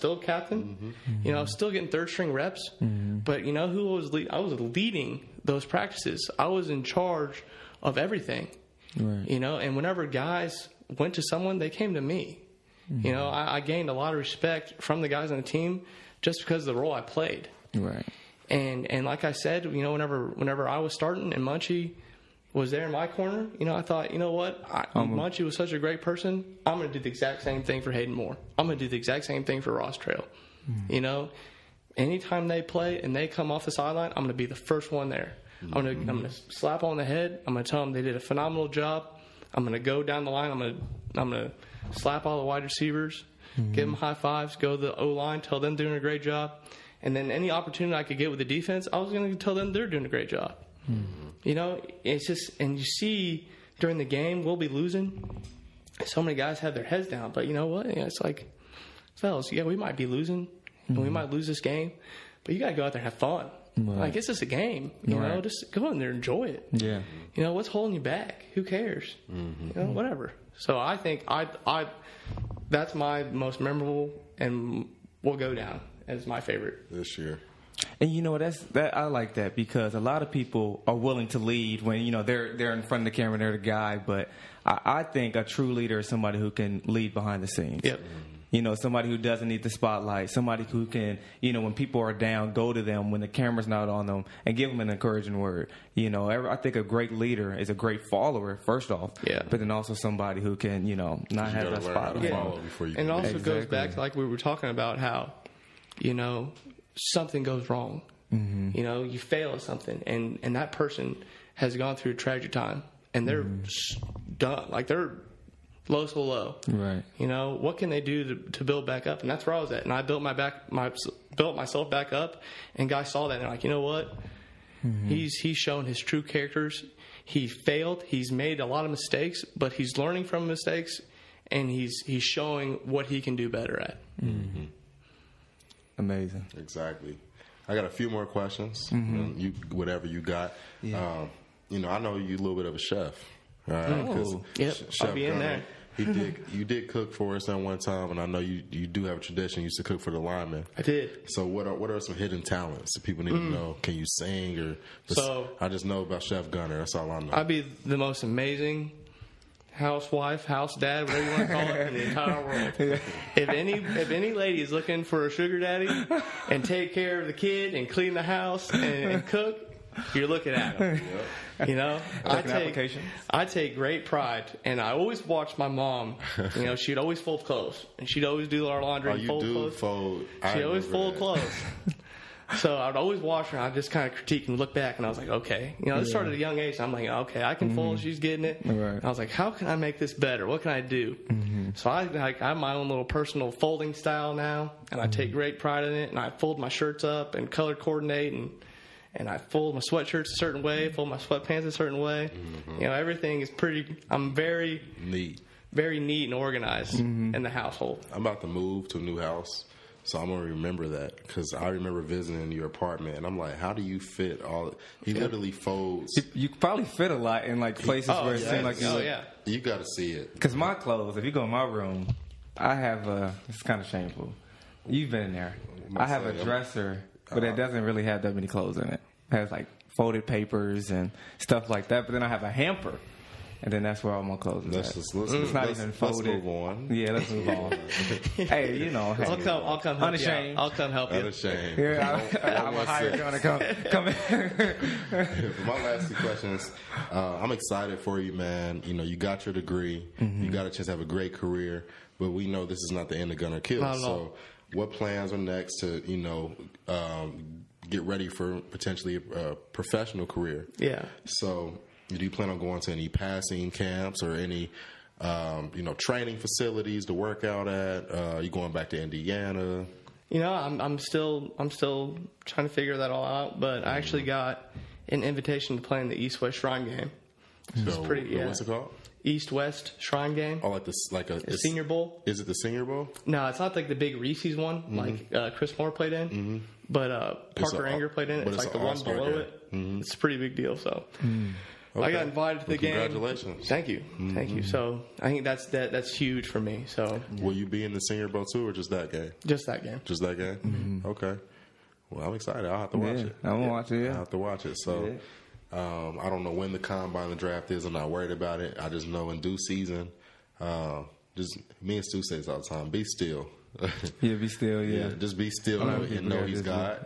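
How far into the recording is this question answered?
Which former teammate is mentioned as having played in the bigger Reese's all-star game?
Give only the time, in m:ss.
4:45.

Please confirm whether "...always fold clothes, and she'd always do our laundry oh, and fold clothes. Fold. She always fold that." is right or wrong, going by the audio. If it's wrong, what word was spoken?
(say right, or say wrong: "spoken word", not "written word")
right.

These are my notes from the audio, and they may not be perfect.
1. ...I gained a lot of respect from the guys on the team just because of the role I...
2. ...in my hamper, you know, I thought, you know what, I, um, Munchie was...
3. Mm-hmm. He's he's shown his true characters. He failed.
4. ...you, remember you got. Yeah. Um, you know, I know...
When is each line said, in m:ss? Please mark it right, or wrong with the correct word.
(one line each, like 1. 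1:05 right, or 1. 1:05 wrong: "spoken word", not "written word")
1. 0:13 right
2. 0:22 wrong: "corner", not "hamper"
3. 2:04 right
4. 2:19 wrong: "whatever", not "remember".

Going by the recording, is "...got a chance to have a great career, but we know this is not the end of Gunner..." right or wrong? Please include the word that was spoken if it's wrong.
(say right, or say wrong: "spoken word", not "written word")
right.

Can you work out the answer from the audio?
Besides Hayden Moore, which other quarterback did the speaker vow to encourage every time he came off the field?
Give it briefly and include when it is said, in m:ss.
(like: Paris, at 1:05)
Ross Trail, at 0:29.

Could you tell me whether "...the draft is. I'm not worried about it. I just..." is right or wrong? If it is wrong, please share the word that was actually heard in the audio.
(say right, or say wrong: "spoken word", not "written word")
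right.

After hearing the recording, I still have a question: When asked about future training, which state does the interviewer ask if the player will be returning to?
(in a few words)
Indiana.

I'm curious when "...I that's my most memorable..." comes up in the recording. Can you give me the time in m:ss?
1:11.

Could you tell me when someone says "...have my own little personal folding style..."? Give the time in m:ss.
3:12.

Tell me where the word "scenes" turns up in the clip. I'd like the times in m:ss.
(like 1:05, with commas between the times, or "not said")
1:27.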